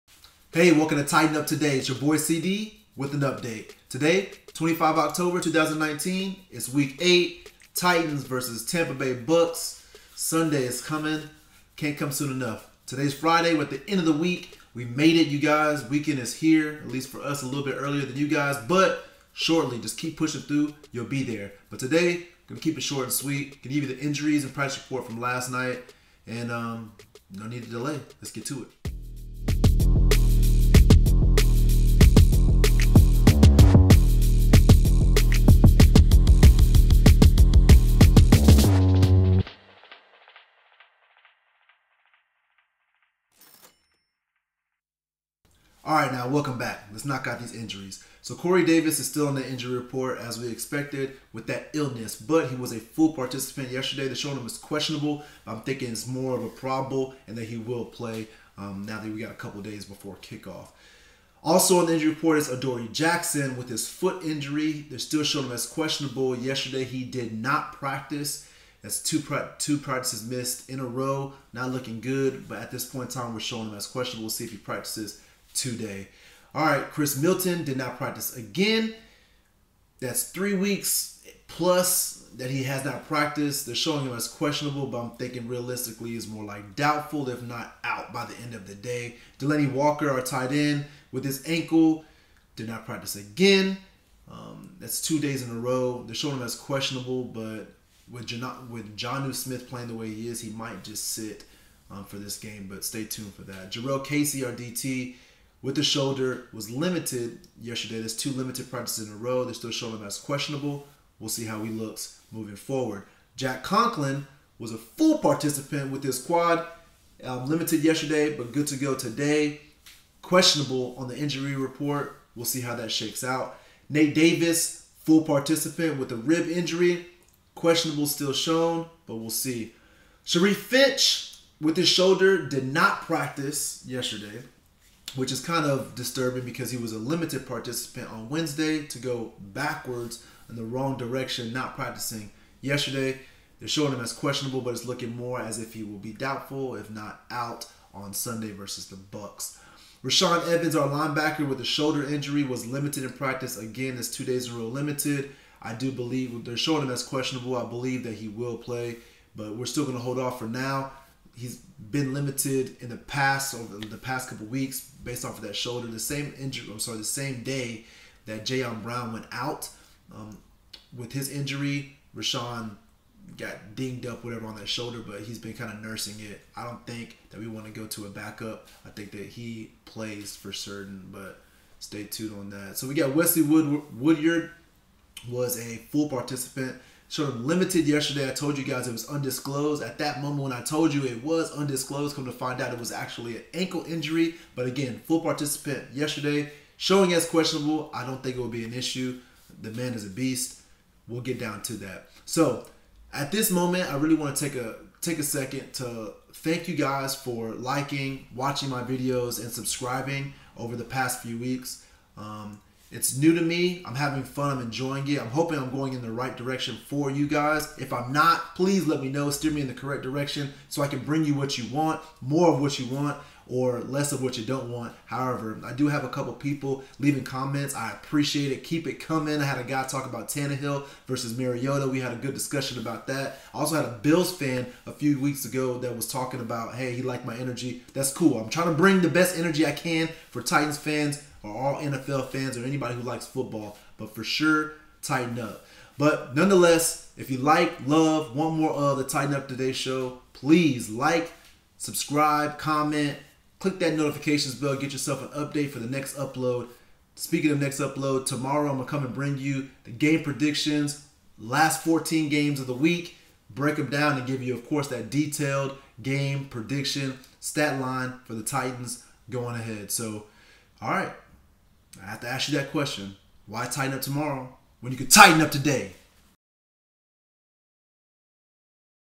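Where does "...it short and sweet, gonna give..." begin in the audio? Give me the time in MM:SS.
00:22.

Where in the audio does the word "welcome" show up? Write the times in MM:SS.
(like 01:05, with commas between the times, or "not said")
00:00, 00:46.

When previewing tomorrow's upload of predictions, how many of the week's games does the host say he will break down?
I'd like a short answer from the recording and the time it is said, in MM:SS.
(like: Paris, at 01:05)
14, at 04:21.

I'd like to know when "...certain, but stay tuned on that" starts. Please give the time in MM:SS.
03:00.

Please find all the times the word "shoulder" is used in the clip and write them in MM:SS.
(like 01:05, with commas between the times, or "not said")
01:45, 02:11, 02:31, 02:45, 02:54.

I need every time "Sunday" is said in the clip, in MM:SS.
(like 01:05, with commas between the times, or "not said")
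00:10, 02:28.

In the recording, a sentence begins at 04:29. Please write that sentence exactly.
So, all right, I have to ask you that question.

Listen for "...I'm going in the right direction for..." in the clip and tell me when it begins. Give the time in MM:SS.
03:35.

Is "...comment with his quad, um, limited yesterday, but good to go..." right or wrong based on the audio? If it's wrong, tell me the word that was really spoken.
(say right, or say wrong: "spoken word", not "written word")
wrong: "participant", not "comment".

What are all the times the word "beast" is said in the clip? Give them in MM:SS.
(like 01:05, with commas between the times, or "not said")
03:20.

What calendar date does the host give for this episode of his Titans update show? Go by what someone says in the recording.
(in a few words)
25 October 2019.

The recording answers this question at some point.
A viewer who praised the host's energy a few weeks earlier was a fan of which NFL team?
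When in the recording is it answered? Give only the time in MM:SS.
03:54.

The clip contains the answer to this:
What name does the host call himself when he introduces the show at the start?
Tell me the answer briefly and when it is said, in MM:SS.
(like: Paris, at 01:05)
CD, at 00:02.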